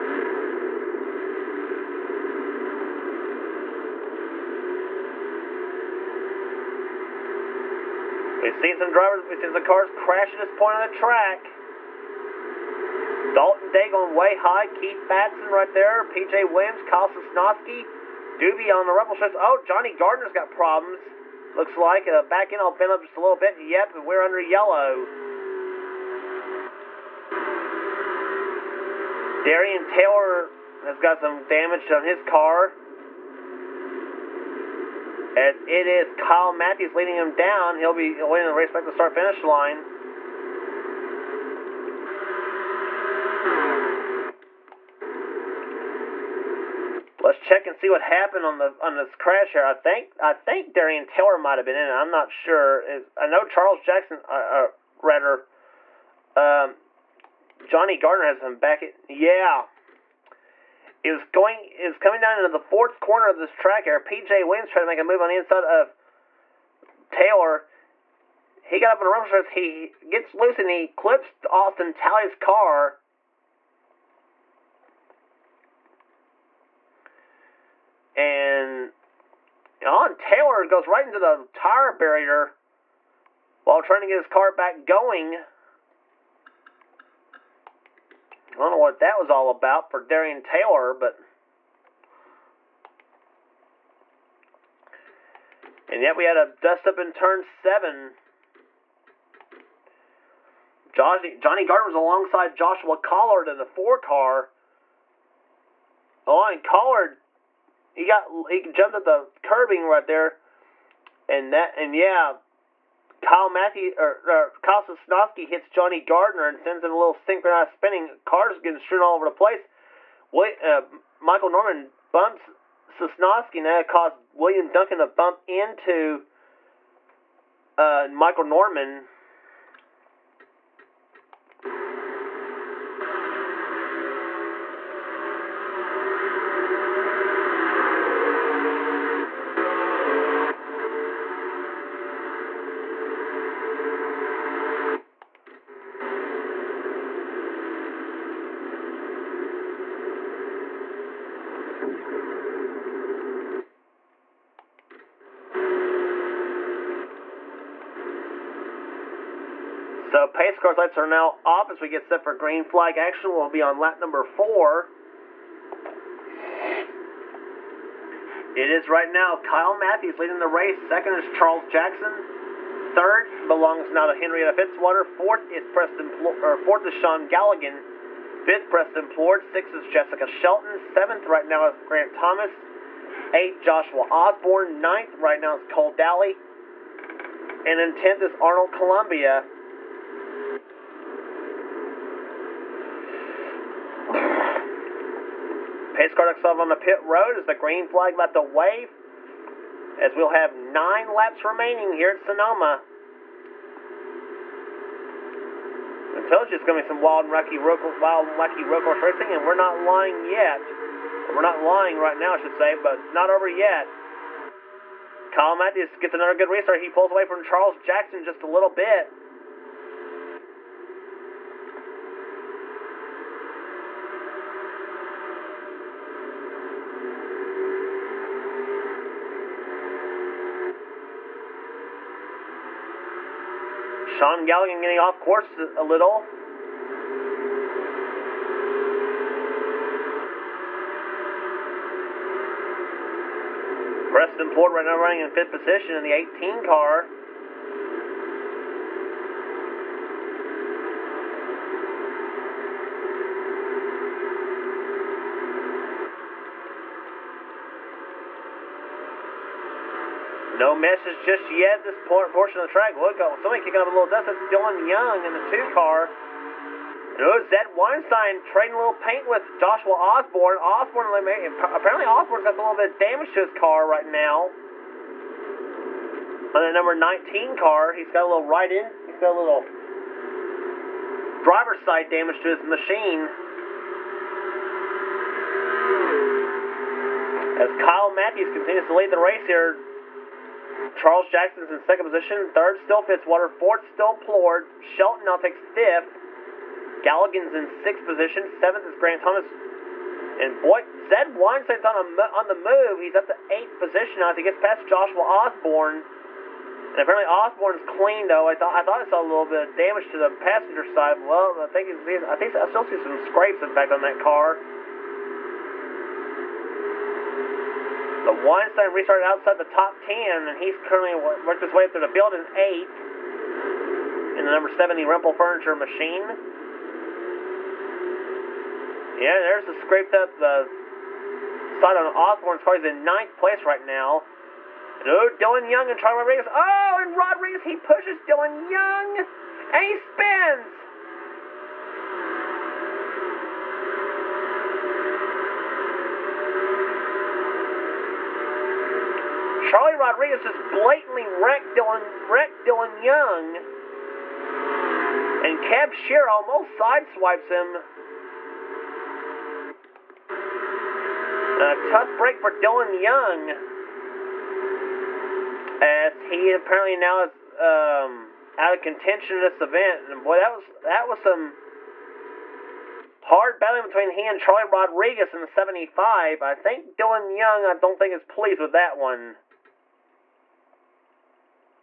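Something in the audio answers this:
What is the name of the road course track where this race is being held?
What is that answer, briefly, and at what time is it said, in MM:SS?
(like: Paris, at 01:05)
Sonoma, at 03:22.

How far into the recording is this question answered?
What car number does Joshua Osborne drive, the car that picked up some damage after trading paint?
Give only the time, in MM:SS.
04:36.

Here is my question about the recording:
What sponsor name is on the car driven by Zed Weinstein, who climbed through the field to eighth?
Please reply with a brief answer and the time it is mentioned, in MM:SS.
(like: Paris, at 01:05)
Rempel Furniture, at 05:25.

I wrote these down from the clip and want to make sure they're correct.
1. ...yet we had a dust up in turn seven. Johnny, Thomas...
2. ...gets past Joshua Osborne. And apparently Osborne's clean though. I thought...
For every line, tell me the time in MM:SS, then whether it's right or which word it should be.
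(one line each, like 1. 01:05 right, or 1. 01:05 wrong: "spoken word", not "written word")
1. 01:36 wrong: "Johnny", not "Thomas"
2. 05:04 right.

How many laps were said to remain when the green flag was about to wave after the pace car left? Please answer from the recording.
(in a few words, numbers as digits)
9.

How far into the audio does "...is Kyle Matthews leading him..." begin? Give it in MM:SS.
00:35.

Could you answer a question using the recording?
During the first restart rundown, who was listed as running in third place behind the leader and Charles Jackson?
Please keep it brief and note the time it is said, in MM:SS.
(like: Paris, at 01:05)
Henrietta Fitzwater, at 02:54.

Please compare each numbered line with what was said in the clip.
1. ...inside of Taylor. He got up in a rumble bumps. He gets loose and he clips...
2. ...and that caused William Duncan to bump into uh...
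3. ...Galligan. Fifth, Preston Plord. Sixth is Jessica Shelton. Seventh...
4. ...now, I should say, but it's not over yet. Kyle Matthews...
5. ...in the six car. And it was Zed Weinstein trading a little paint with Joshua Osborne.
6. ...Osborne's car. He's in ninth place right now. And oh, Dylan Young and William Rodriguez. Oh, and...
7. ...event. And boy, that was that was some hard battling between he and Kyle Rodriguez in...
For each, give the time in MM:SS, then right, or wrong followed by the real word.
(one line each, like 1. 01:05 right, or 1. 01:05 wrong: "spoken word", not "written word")
1. 01:05 wrong: "strips", not "bumps"
2. 02:03 right
3. 02:57 right
4. 03:32 right
5. 04:25 wrong: "two", not "six"
6. 05:32 wrong: "Charlie", not "William"
7. 06:09 wrong: "Charlie", not "Kyle".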